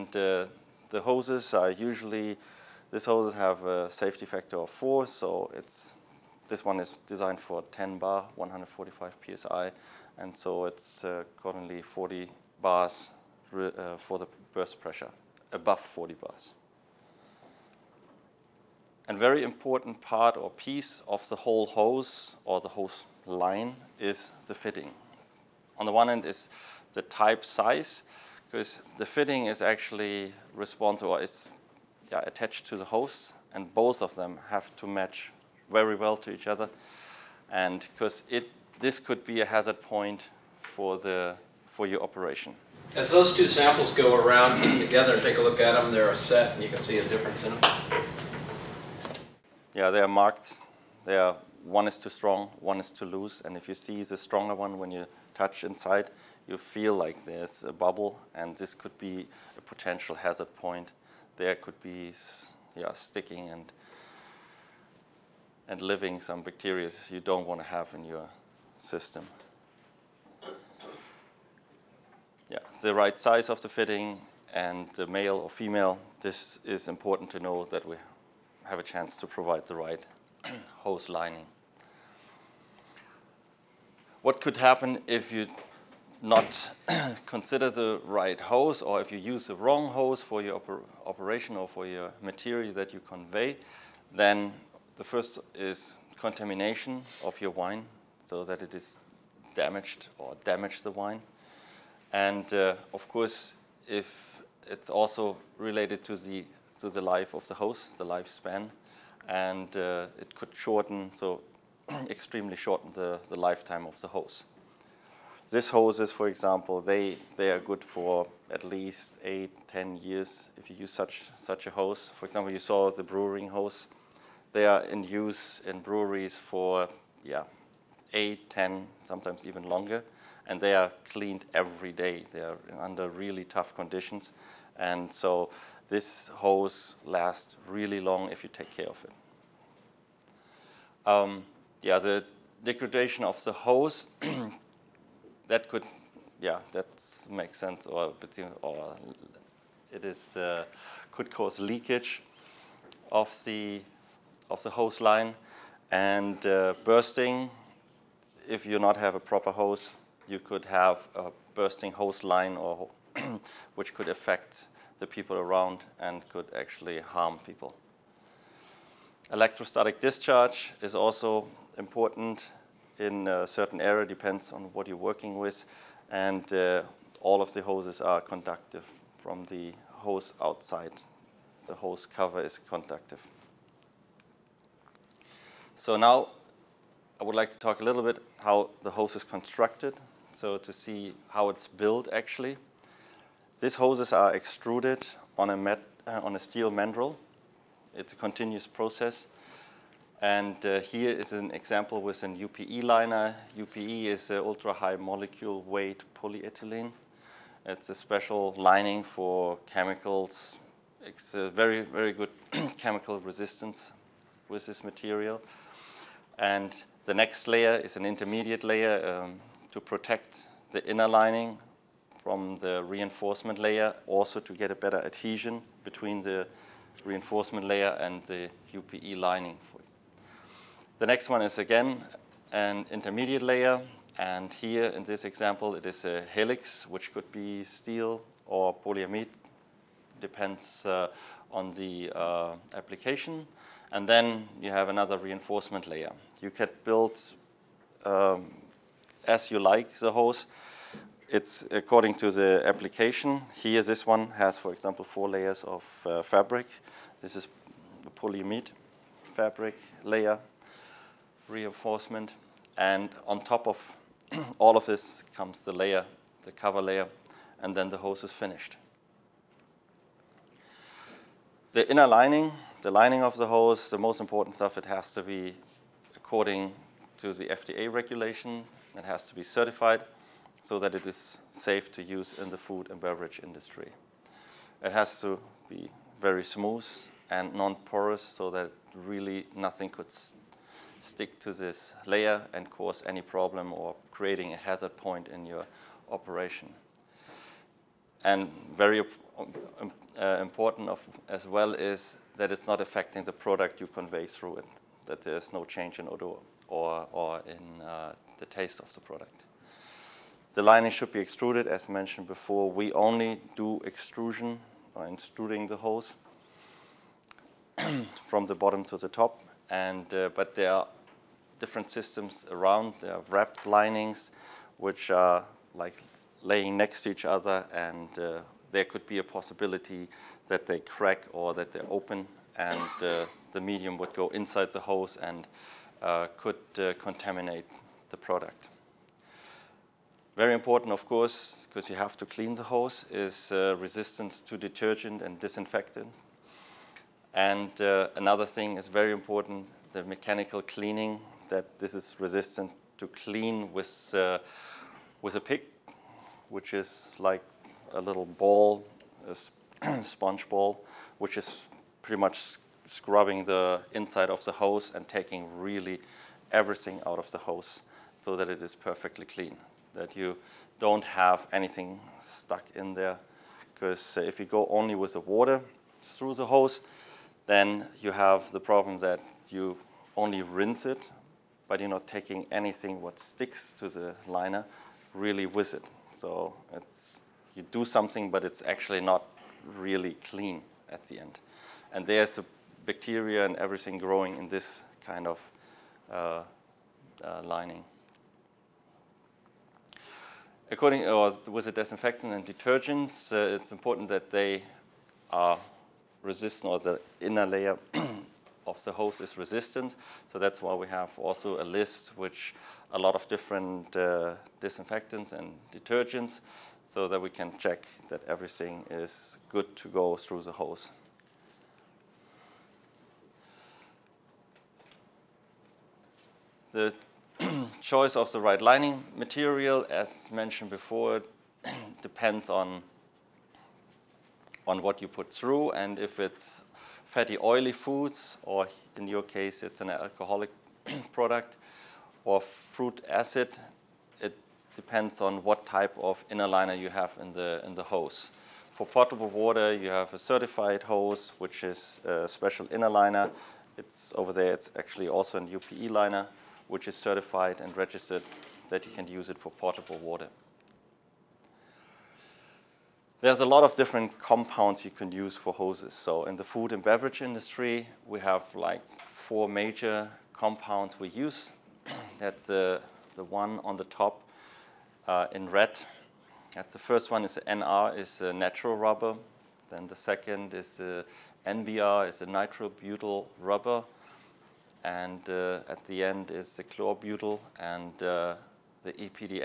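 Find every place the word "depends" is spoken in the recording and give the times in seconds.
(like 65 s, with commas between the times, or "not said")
174 s, 240 s, 432 s, 444 s.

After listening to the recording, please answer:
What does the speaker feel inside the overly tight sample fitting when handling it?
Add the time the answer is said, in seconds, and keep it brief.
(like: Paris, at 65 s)
A bubble, at 57 s.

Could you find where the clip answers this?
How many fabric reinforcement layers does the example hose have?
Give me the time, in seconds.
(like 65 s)
255 s.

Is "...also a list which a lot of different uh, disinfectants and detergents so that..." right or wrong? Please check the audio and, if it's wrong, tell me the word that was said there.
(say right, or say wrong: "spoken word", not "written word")
right.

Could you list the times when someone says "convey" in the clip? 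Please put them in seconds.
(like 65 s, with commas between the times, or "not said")
92 s, 303 s.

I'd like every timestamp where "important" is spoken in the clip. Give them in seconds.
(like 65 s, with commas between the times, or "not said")
19 s, 76 s, 171 s, 274 s, 300 s, 340 s, 349 s, 403 s.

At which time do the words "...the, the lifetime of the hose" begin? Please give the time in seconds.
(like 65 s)
112 s.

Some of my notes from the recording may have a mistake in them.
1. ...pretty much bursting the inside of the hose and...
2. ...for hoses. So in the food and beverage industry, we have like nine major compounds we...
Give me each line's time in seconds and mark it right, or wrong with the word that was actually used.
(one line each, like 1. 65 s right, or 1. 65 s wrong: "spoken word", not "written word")
1. 362 s wrong: "scrubbing", not "bursting"
2. 465 s wrong: "four", not "nine".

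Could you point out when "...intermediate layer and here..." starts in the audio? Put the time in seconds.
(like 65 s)
232 s.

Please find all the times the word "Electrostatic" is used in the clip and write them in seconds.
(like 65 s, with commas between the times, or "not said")
169 s.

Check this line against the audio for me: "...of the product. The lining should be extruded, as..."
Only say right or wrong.
right.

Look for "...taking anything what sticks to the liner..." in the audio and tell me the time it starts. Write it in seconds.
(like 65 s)
382 s.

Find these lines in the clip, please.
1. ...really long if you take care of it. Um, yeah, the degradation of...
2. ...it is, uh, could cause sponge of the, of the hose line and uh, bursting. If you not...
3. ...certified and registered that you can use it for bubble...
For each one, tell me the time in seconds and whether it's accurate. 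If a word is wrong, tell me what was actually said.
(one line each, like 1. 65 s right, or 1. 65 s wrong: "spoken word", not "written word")
1. 137 s right
2. 149 s wrong: "leakage", not "sponge"
3. 456 s wrong: "portable", not "bubble".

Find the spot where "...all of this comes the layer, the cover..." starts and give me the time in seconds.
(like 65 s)
264 s.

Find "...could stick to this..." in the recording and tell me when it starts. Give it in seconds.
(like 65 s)
289 s.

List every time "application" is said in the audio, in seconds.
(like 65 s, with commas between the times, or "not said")
242 s, 252 s.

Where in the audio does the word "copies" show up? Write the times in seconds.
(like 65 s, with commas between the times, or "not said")
not said.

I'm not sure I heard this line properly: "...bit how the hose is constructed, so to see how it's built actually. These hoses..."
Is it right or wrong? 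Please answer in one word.
right.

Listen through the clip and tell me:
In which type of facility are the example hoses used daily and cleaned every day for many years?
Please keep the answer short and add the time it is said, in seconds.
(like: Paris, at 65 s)
Breweries, at 125 s.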